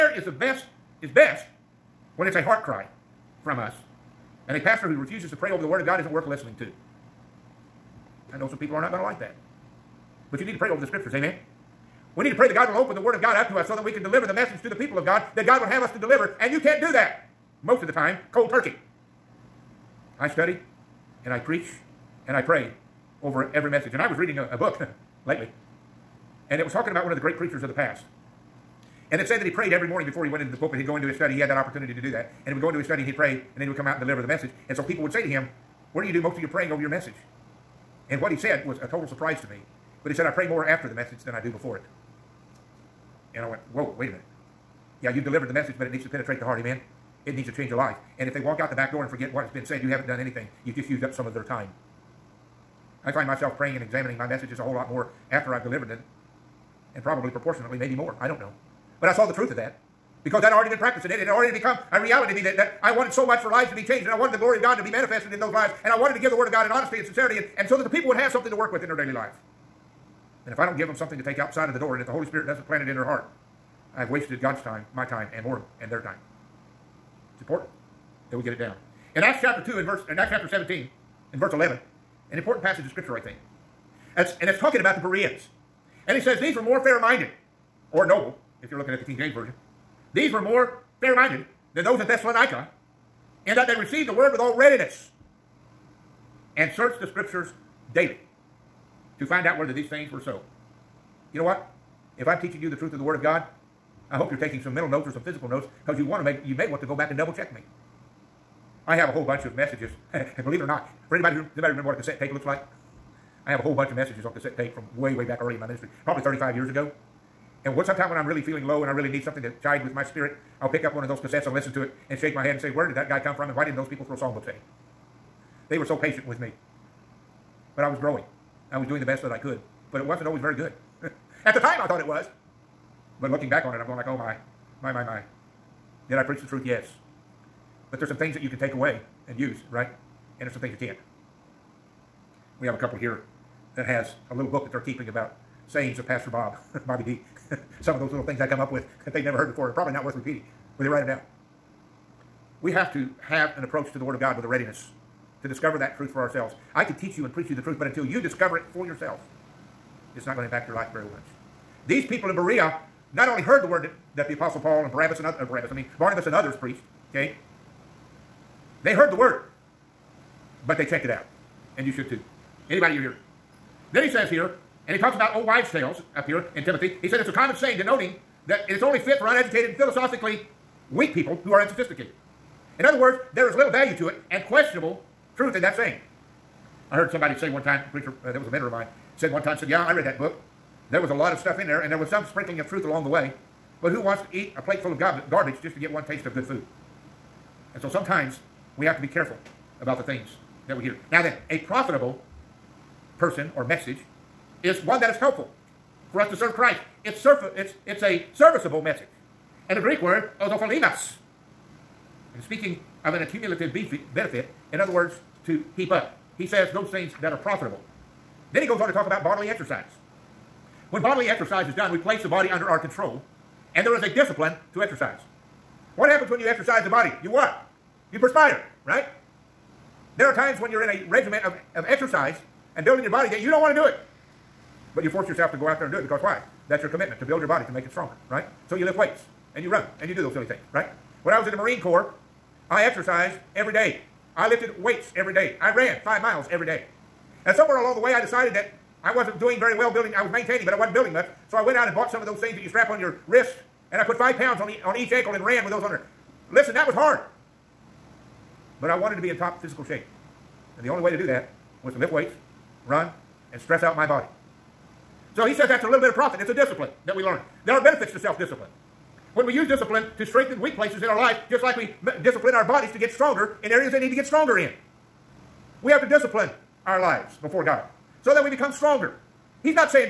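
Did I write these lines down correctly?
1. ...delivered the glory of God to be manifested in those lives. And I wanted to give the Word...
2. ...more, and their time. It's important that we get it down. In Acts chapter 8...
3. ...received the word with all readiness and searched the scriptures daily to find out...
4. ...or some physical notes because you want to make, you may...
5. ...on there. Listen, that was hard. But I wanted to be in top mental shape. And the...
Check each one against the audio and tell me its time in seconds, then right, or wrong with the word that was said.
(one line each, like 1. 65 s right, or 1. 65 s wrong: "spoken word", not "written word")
1. 64 s wrong: "wanted", not "delivered"
2. 75 s wrong: "2", not "8"
3. 93 s right
4. 105 s right
5. 255 s wrong: "physical", not "mental".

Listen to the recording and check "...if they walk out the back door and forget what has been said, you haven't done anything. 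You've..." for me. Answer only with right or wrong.
right.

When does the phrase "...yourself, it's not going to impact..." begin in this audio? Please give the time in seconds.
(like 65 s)
158 s.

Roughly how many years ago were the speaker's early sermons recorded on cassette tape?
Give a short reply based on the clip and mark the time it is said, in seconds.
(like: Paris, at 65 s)
35 years, at 116 s.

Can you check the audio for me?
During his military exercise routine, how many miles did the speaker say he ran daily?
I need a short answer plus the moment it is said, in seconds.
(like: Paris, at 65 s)
5 miles, at 246 s.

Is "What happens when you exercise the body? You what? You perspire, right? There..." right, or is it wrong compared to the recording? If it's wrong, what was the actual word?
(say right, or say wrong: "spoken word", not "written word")
right.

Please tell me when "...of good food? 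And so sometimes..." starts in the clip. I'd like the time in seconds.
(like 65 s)
196 s.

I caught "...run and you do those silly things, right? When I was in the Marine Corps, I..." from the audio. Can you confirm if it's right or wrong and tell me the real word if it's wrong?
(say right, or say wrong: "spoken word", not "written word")
right.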